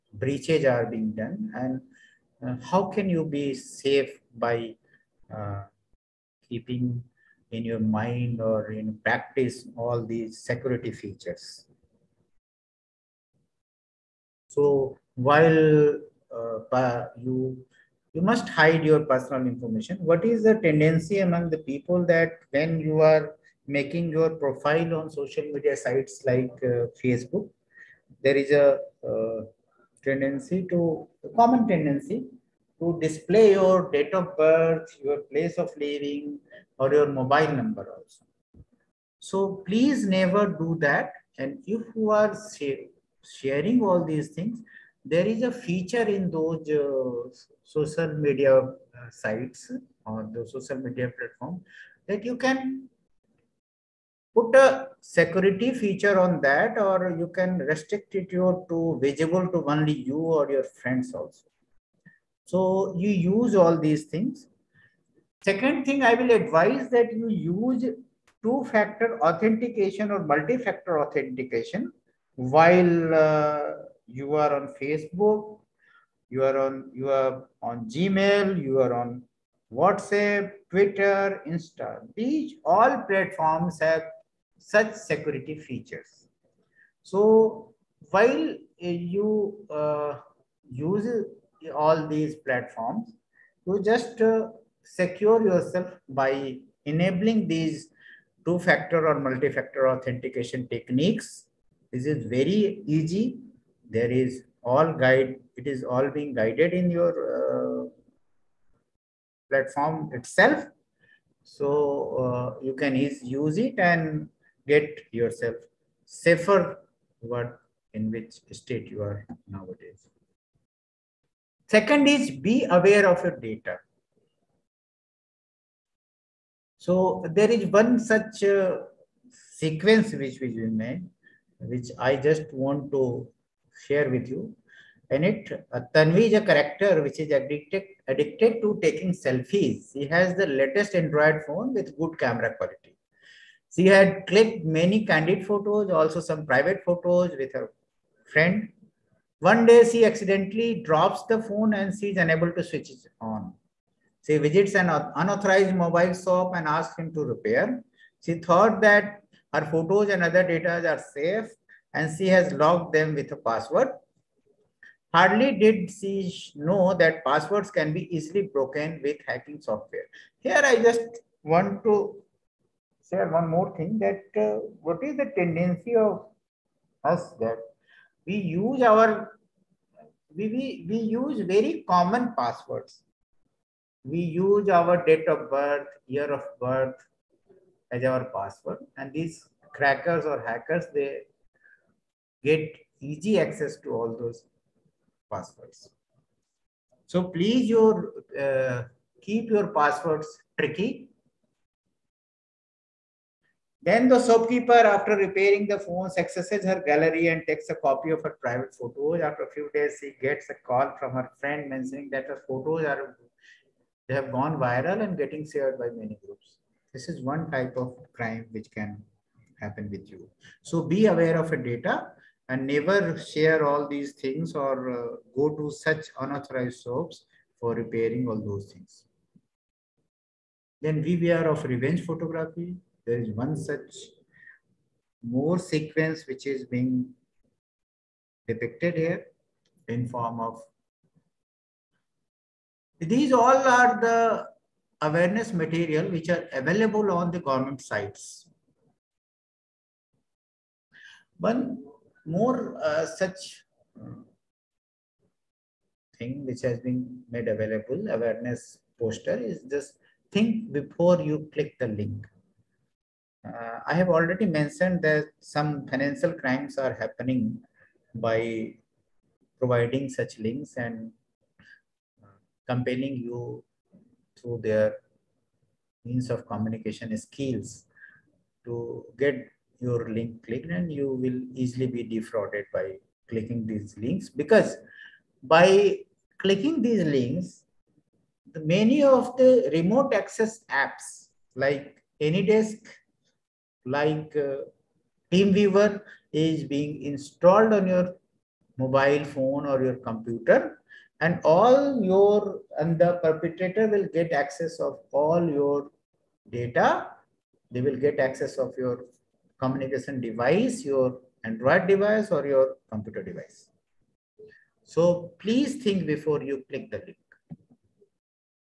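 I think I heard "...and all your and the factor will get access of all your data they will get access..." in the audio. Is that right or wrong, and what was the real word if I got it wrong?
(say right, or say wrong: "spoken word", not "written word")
wrong: "perpetrator", not "factor".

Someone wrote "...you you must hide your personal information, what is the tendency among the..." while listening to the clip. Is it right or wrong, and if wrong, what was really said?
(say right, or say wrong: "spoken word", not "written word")
right.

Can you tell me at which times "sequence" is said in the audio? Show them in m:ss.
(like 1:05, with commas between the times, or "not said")
2:09, 3:55.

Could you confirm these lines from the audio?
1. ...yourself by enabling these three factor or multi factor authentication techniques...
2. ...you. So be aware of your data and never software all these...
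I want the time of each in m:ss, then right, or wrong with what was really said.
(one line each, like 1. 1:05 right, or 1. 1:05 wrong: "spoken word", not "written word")
1. 1:35 wrong: "two", not "three"
2. 3:40 wrong: "share", not "software".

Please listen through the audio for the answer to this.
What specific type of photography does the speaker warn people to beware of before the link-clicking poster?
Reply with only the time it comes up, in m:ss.
3:51.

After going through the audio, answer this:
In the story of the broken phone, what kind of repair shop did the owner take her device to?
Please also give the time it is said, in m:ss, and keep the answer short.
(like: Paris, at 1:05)
unauthorized mobile shop, at 2:34.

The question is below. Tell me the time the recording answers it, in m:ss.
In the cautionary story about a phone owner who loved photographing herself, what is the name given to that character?
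2:15.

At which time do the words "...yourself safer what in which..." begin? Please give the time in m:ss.
1:55.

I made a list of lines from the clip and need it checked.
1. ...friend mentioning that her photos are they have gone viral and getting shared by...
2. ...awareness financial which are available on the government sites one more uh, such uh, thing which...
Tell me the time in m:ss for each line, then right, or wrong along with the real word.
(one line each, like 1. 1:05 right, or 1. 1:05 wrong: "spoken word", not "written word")
1. 3:31 right
2. 4:05 wrong: "material", not "financial".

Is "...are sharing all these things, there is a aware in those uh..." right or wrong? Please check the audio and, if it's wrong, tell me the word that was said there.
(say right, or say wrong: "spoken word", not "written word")
wrong: "feature", not "aware".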